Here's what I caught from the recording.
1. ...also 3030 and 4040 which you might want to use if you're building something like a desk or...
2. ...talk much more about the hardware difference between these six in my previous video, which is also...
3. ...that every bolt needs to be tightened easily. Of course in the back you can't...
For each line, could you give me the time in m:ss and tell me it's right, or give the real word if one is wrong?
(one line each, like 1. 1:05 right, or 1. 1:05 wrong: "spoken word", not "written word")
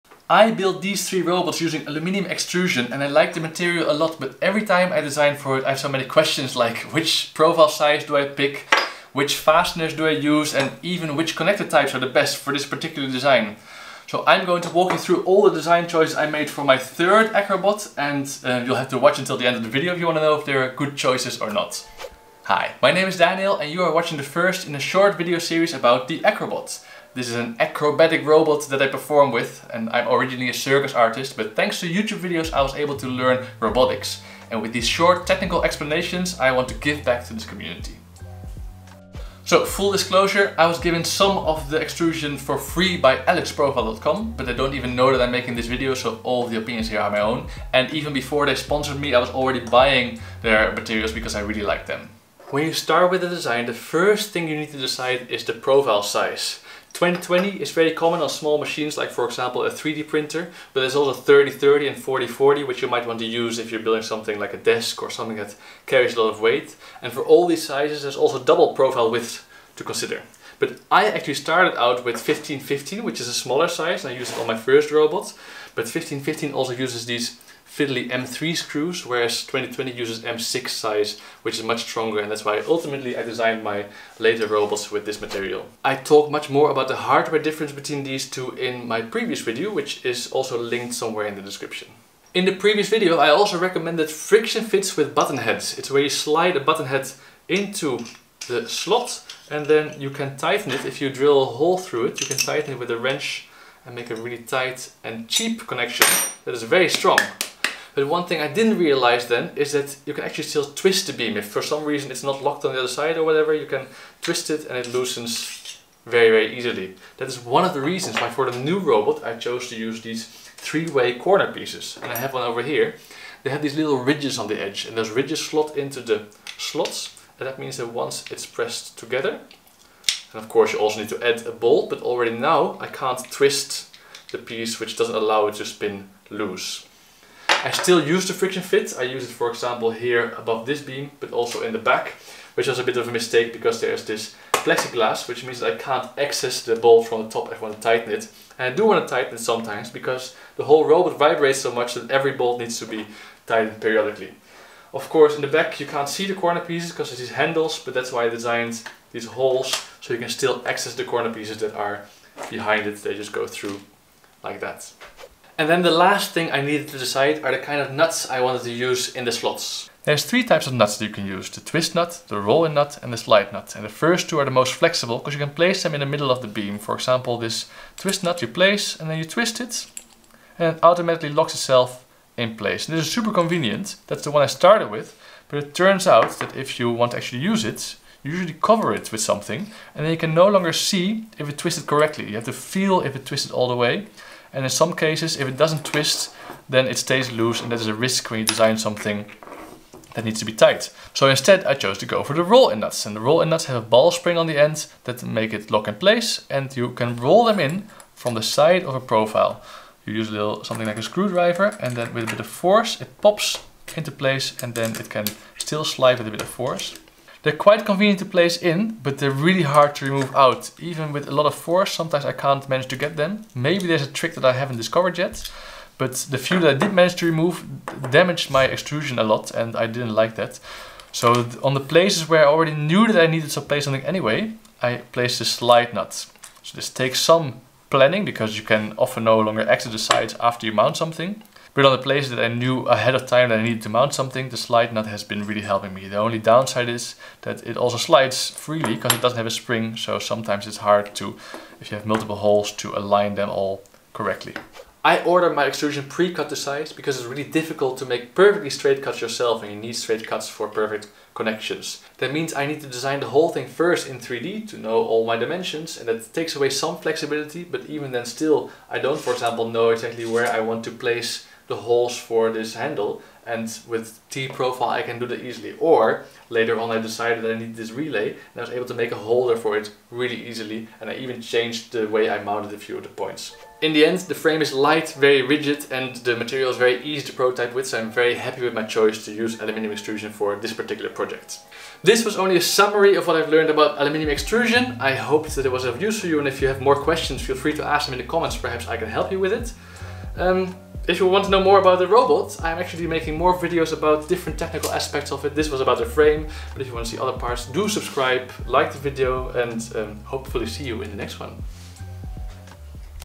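1. 1:00 right
2. 1:25 wrong: "two", not "six"
3. 2:31 wrong: "periodically", not "easily".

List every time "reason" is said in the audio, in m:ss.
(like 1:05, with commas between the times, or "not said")
1:51, 1:57.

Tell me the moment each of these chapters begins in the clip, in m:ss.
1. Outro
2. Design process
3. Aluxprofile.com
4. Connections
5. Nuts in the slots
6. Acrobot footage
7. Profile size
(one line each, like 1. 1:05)
1. 4:44
2. 4:14
3. 0:39
4. 1:32
5. 2:45
6. 0:26
7. 0:52.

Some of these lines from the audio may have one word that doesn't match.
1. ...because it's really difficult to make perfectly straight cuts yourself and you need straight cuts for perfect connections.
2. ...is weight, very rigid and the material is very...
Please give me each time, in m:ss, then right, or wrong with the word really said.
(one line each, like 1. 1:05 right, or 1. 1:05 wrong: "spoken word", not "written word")
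1. 4:16 right
2. 4:44 wrong: "light", not "weight".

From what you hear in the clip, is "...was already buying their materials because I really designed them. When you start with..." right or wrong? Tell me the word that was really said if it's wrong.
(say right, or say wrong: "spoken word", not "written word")
wrong: "liked", not "designed".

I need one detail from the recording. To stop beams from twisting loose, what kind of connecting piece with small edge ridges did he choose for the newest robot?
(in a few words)
three-way corner pieces.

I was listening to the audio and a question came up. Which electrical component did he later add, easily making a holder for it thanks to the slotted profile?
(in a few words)
relay.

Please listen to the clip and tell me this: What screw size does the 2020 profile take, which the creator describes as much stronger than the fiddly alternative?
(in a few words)
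M6.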